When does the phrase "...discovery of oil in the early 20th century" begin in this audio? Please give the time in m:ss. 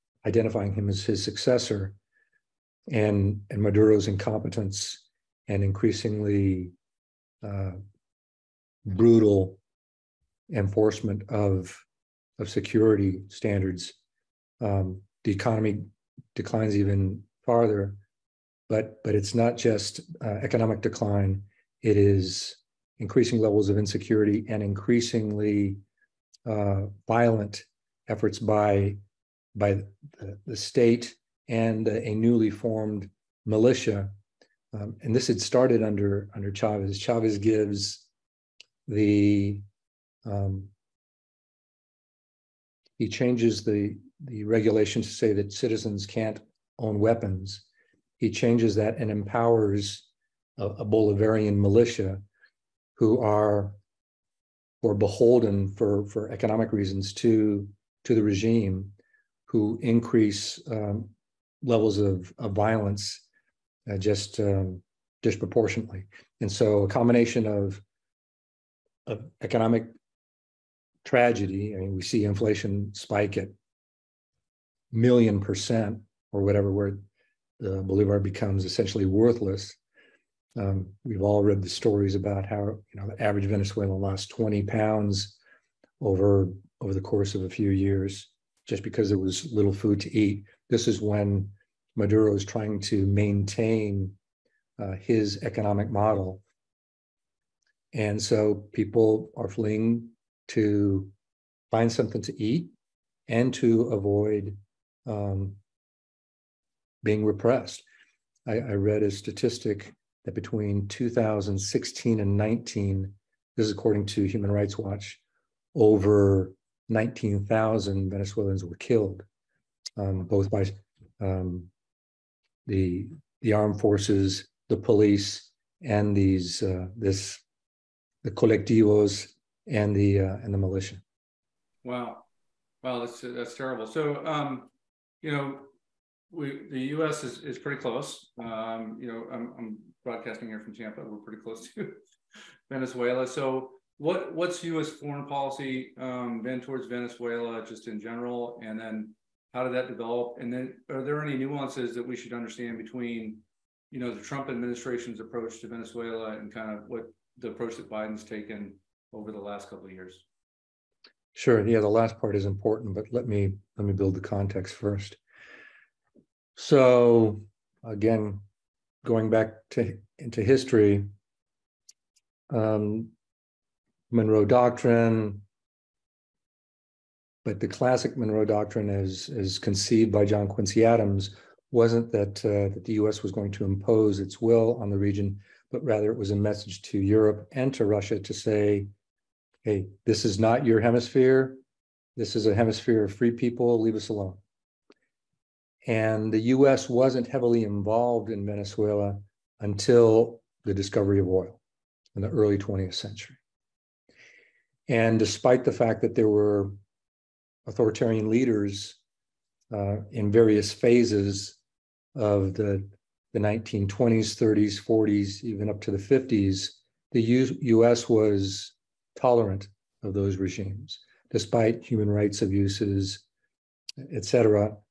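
3:20.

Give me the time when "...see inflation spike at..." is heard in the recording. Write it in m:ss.
1:12.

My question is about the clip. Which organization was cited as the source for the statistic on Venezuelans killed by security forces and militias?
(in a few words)
Human Rights Watch.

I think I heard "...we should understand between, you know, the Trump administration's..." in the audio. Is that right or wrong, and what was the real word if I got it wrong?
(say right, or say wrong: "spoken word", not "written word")
right.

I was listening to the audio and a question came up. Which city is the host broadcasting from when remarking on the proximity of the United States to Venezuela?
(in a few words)
Tampa.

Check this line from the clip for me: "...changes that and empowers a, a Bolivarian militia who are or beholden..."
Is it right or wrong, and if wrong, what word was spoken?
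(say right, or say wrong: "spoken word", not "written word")
right.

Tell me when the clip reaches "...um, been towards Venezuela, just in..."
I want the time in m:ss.
2:25.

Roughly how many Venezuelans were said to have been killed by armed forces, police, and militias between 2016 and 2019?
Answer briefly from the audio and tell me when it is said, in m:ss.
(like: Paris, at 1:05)
19,000, at 1:56.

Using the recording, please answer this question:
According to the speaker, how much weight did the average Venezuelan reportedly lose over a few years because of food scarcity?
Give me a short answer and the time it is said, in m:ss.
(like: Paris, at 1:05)
20 pounds, at 1:24.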